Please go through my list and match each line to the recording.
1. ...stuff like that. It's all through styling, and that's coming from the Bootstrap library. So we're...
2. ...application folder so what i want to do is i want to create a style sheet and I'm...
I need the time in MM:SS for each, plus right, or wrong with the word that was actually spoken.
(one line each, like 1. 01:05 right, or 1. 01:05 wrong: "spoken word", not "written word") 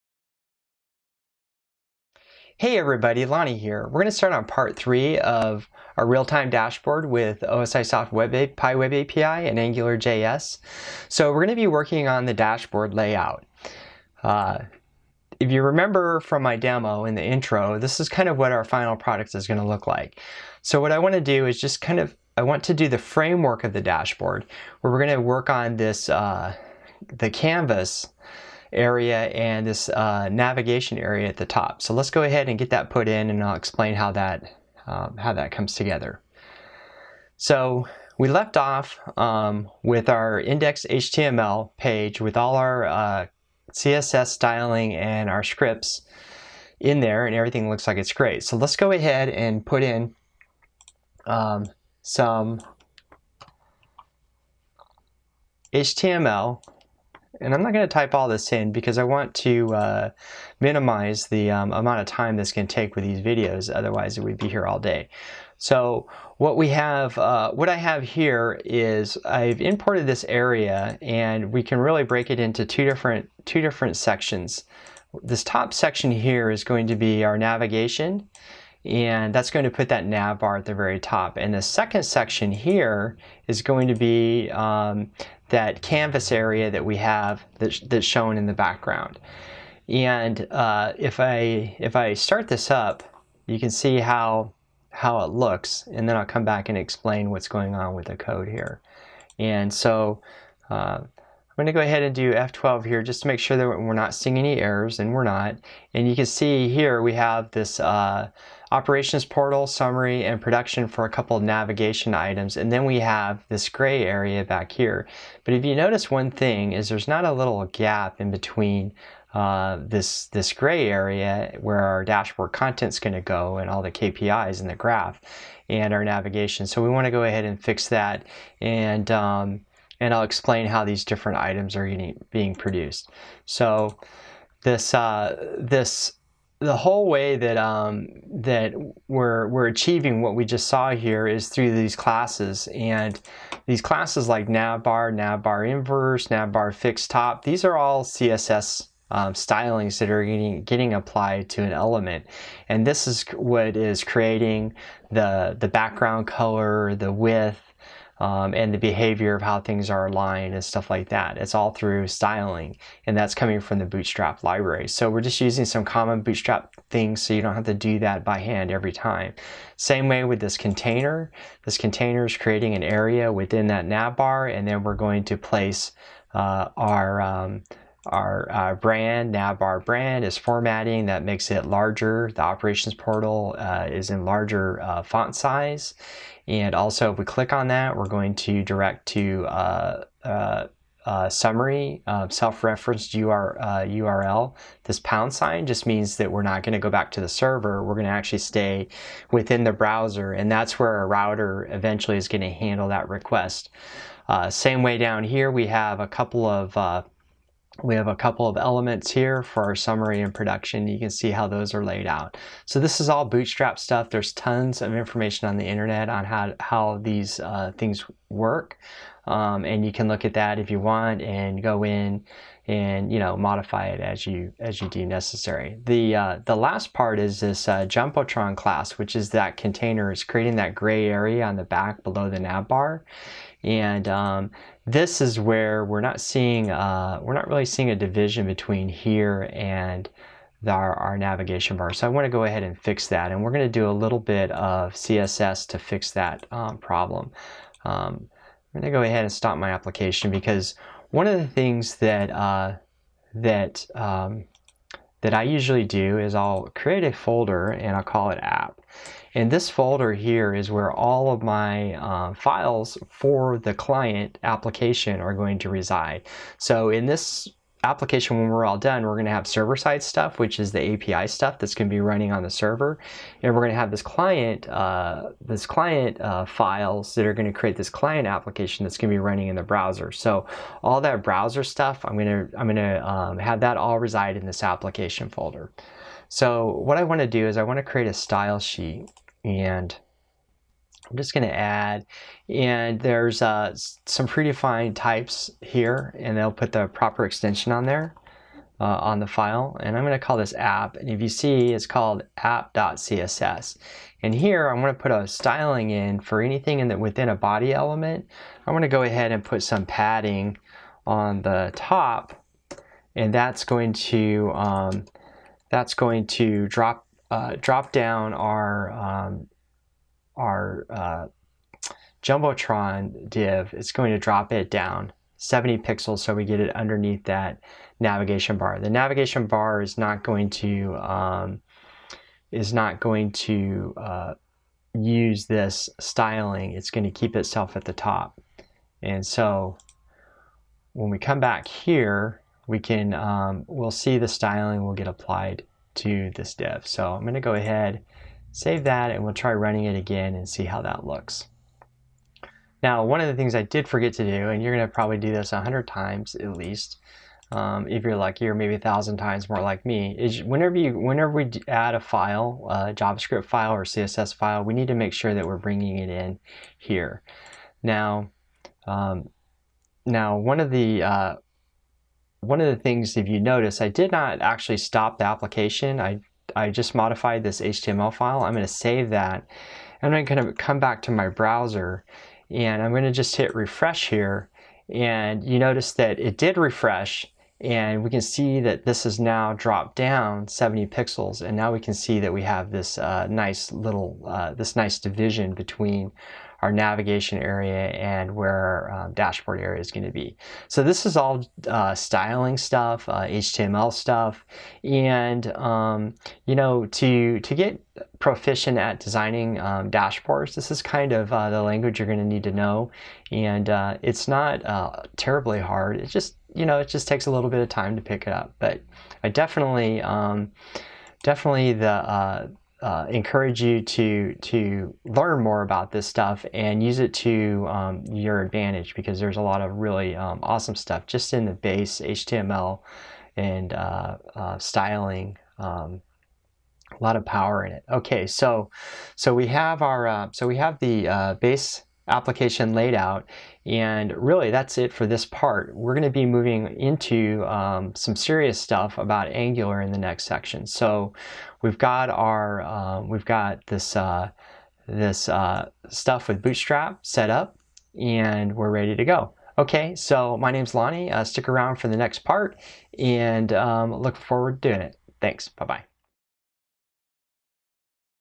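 1. 02:40 right
2. 04:44 right.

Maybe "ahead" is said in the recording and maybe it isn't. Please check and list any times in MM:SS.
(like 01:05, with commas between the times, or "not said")
00:32, 00:48, 01:41, 02:07, 04:02, 04:09, 05:09, 05:47.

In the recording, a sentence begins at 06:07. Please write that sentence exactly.
Now, um, now one of the uh, one of the things, if you notice, I did not actually stop the application.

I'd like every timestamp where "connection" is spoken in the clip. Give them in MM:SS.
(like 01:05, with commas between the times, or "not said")
not said.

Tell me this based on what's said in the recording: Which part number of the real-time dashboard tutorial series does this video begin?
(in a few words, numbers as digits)
3.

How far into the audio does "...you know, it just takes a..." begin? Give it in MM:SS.
06:56.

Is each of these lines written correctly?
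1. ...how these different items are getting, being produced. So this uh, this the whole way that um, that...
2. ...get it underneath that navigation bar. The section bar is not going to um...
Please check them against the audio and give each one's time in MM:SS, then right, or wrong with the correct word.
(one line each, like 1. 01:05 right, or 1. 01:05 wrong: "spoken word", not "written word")
1. 02:10 right
2. 05:26 wrong: "navigation", not "section".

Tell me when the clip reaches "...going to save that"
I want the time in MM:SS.
06:18.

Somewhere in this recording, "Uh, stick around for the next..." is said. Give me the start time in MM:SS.
07:41.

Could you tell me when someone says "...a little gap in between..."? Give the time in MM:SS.
01:57.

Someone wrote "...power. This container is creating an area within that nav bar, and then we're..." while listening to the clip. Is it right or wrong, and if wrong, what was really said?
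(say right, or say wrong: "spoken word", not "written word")
wrong: "container", not "power".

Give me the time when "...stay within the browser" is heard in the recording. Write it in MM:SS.
03:18.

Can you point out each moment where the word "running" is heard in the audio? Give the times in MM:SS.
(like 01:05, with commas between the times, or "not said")
04:31, 04:39, 05:49.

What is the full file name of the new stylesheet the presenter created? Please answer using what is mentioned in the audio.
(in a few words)
app.css.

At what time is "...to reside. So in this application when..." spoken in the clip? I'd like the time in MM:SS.
04:25.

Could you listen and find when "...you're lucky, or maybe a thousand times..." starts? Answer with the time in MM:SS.
05:58.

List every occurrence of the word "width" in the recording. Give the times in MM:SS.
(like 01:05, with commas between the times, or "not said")
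02:37.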